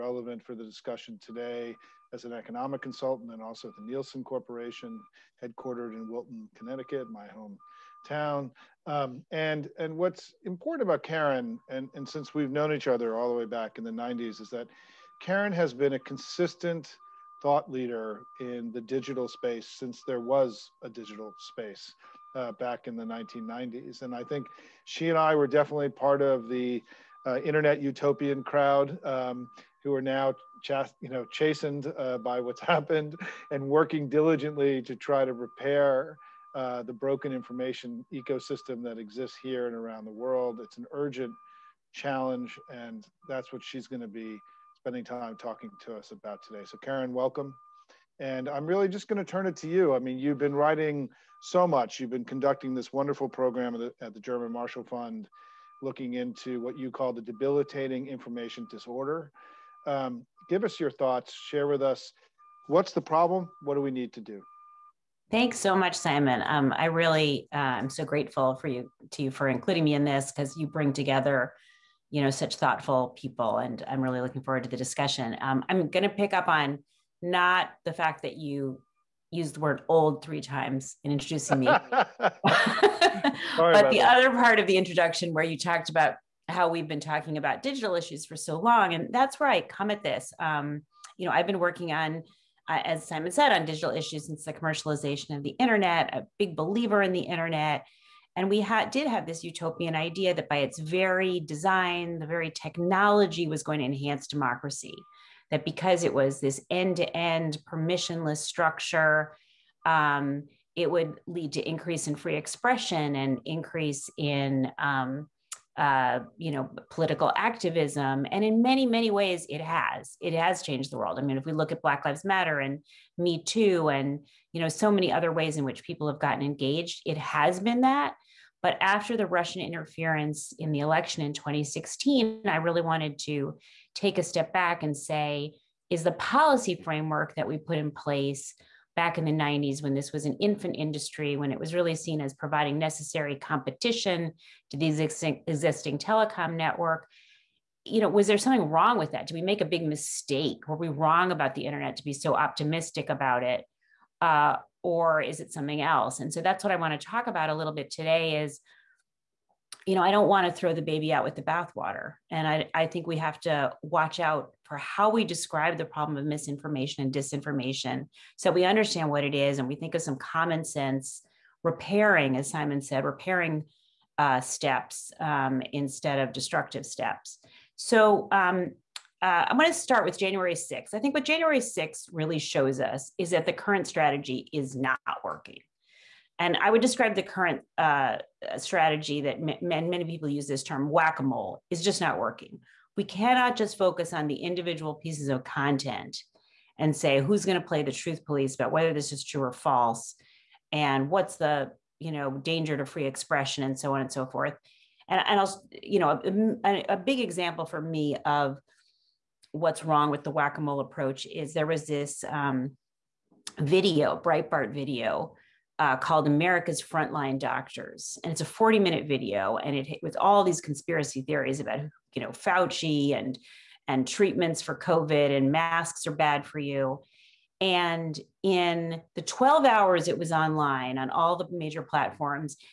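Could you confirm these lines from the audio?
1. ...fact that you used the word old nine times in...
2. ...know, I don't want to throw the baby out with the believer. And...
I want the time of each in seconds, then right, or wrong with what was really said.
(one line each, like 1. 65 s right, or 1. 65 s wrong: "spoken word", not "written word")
1. 77 s wrong: "three", not "nine"
2. 159 s wrong: "bathwater", not "believer".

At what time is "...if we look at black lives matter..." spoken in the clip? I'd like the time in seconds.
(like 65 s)
121 s.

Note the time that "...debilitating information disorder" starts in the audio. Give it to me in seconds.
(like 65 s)
57 s.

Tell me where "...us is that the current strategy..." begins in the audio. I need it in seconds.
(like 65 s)
182 s.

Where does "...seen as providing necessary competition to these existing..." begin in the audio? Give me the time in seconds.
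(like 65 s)
141 s.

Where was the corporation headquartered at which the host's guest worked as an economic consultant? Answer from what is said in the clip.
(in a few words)
Wilton, Connecticut.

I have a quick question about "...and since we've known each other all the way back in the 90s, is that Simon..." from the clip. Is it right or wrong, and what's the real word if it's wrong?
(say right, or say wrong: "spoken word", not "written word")
wrong: "Karen", not "Simon".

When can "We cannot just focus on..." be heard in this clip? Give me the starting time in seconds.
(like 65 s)
192 s.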